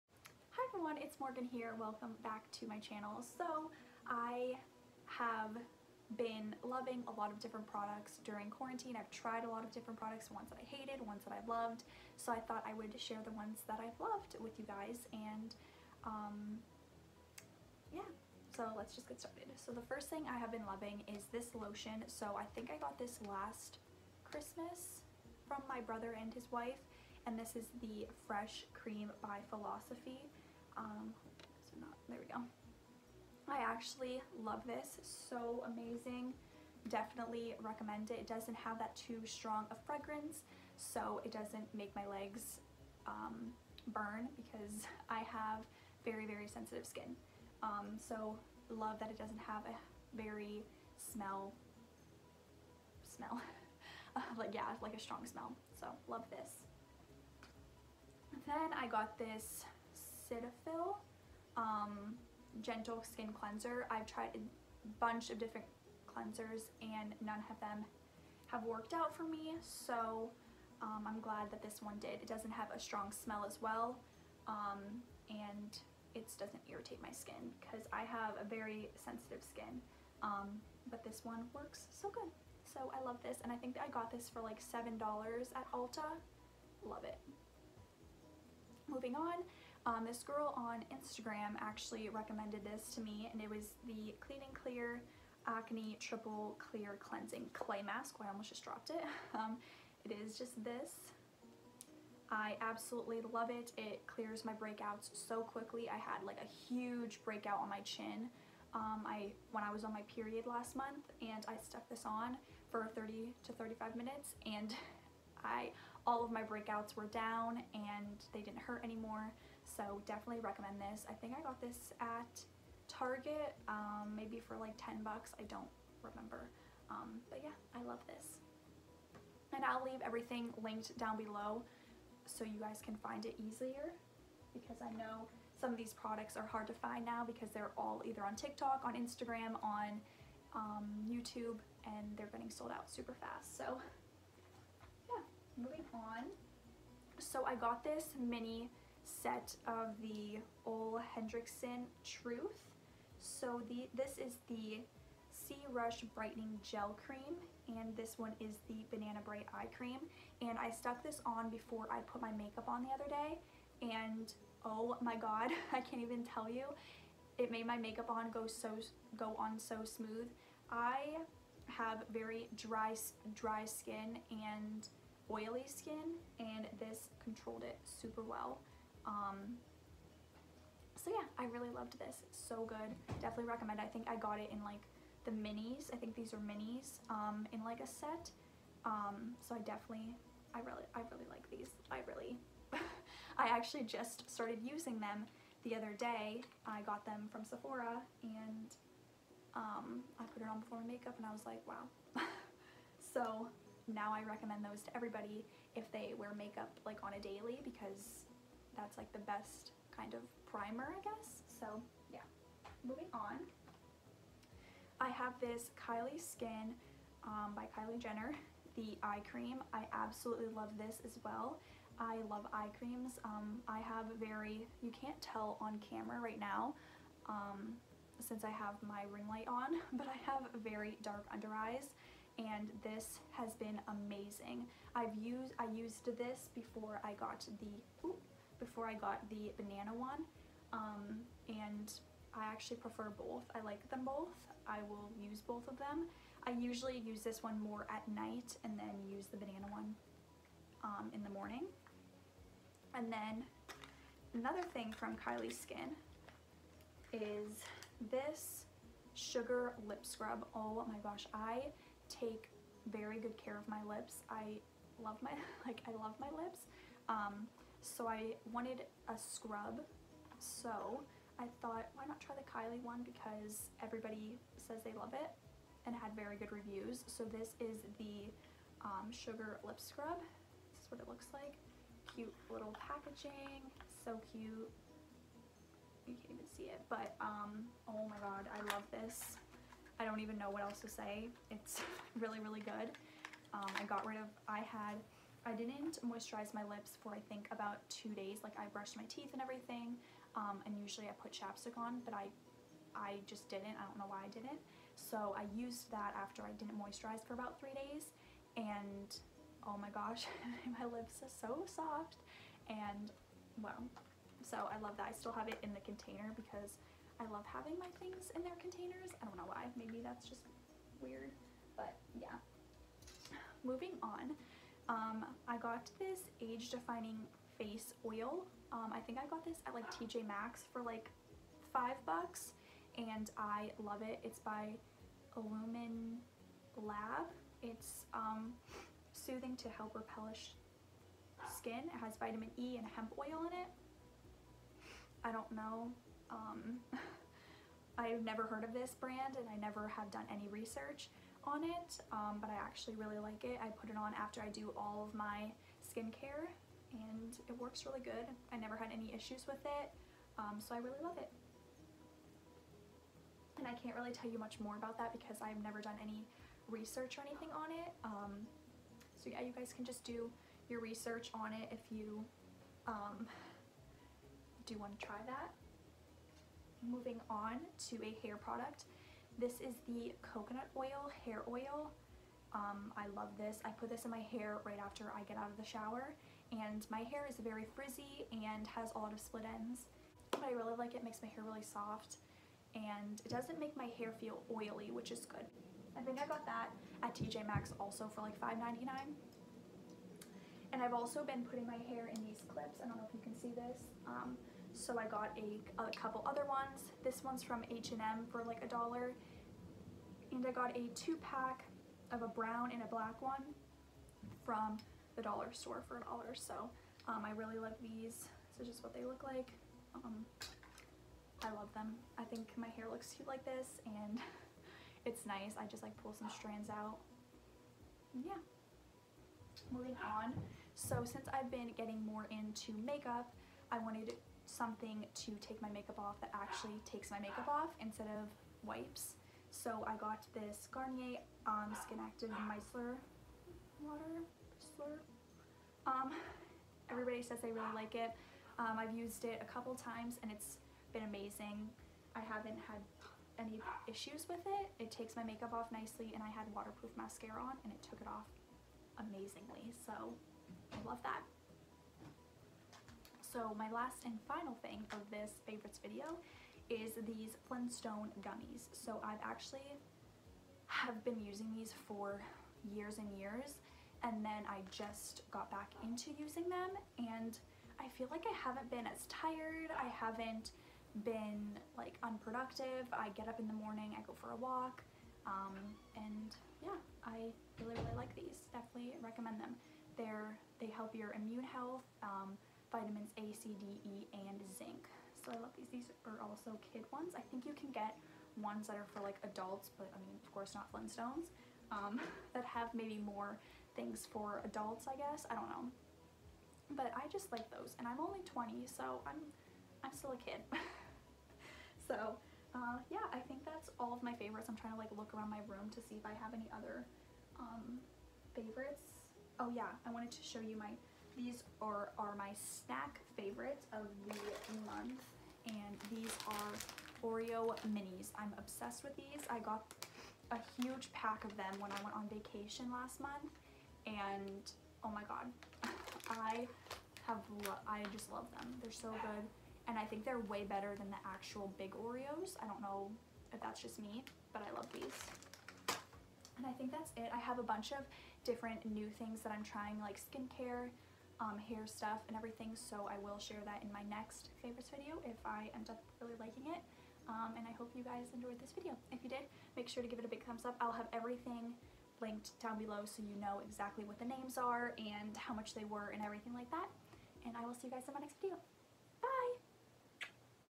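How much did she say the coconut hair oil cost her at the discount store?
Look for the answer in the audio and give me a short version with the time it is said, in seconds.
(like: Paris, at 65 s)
$5.99, at 398 s.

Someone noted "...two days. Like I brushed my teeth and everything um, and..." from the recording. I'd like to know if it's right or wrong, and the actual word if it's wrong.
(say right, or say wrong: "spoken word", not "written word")
right.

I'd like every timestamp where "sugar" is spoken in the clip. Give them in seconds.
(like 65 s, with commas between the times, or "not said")
259 s, 279 s.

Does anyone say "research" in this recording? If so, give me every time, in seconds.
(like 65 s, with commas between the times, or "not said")
350 s, 366 s, 370 s.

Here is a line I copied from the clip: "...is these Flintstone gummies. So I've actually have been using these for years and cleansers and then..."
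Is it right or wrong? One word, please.
wrong.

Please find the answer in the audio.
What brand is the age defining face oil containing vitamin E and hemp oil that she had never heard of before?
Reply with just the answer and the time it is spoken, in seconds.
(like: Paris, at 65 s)
Illumine Lab, at 335 s.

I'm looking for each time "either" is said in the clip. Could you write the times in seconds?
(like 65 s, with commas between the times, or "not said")
138 s.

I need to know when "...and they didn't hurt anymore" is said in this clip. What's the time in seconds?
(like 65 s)
117 s.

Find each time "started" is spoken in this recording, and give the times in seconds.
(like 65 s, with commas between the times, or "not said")
19 s, 194 s.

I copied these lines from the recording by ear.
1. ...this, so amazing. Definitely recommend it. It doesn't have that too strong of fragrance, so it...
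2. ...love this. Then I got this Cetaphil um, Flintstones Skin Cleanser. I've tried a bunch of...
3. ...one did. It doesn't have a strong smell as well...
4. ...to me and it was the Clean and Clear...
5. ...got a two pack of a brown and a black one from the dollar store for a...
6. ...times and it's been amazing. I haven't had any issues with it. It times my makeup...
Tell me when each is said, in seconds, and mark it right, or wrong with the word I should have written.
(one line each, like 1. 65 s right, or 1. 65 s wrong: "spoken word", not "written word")
1. 34 s right
2. 56 s wrong: "Gentle", not "Flintstones"
3. 71 s right
4. 92 s right
5. 410 s right
6. 449 s wrong: "takes", not "times".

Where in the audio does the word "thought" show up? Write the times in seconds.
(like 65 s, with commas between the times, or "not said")
12 s, 271 s.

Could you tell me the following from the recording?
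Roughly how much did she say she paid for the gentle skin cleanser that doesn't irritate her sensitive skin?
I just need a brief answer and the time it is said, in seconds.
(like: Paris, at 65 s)
$7, at 84 s.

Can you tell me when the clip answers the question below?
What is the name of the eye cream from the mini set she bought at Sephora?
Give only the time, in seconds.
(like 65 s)
158 s.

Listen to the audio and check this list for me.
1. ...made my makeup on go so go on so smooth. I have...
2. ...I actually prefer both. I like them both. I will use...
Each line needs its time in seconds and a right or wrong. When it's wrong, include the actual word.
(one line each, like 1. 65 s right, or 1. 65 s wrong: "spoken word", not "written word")
1. 167 s right
2. 242 s right.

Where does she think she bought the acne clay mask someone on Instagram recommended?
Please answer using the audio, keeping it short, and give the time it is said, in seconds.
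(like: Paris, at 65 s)
Target, at 122 s.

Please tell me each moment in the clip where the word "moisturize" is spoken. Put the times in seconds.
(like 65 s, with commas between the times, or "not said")
296 s, 306 s.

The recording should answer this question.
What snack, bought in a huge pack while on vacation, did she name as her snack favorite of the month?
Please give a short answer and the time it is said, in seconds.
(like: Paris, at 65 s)
Oreo minis, at 527 s.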